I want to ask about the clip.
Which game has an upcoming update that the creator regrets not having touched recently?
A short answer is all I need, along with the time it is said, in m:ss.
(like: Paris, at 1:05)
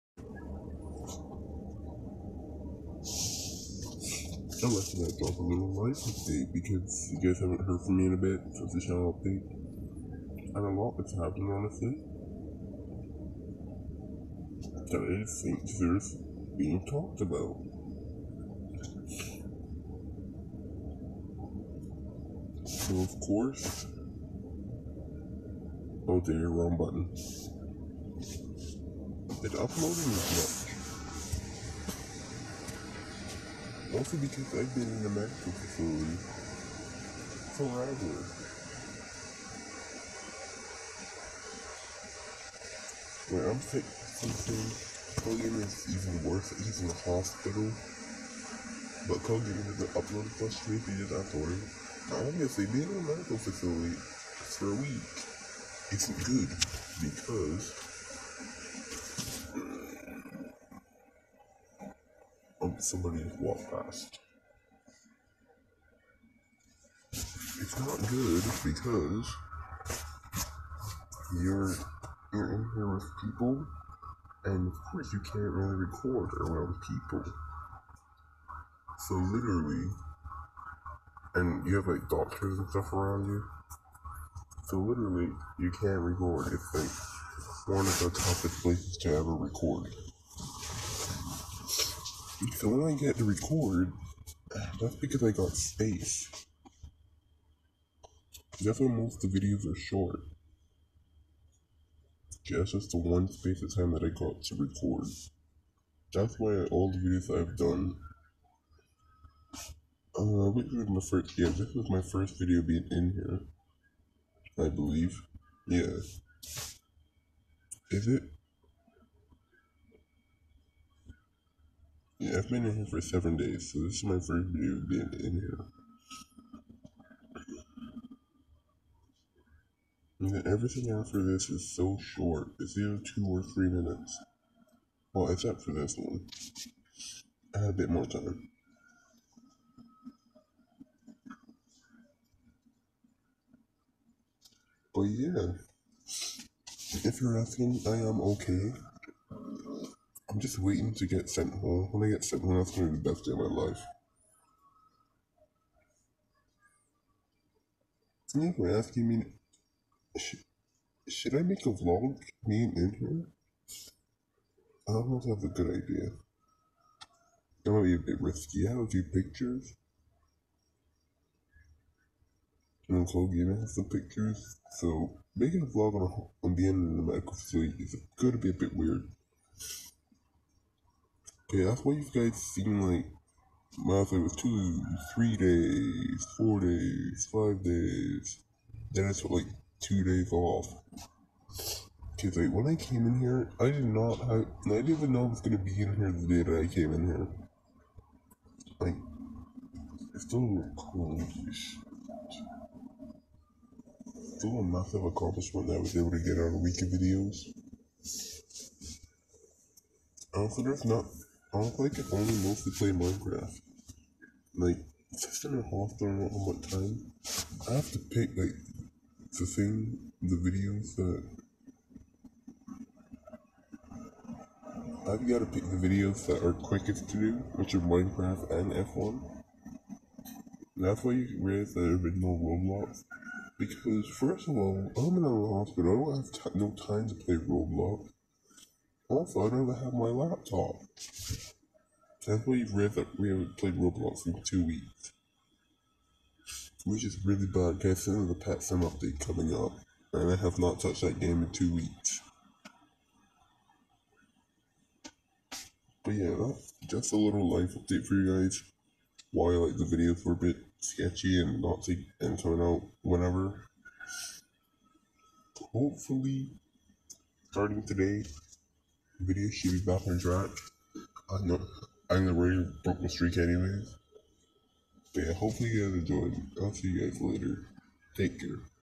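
Pet Sim, at 4:08.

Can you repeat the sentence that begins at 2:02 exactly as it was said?
Yeah, I've been in here for seven days, so this is my first video being in here.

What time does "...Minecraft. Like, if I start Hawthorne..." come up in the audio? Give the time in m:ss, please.
3:32.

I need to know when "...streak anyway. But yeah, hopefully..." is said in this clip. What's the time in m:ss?
4:33.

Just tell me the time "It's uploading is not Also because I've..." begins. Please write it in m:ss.
0:29.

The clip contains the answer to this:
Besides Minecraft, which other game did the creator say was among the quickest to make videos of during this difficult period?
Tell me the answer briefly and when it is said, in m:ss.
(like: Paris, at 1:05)
F1, at 3:48.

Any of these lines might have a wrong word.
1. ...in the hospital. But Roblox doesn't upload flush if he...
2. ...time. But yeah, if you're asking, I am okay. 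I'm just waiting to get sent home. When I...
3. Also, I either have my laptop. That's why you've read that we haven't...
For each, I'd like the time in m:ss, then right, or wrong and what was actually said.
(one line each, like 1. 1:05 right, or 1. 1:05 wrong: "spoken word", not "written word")
1. 0:46 wrong: "Kogan", not "Roblox"
2. 2:18 right
3. 3:59 wrong: "never", not "either".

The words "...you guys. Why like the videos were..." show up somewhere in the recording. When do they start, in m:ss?
4:18.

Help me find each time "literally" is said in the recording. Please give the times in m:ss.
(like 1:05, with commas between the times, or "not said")
1:19, 1:24.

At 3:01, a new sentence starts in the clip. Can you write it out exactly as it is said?
Okay, that's why you guys seem like my flight was two, three days, four days, five days.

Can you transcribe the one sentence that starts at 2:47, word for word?
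That might be a bit risky.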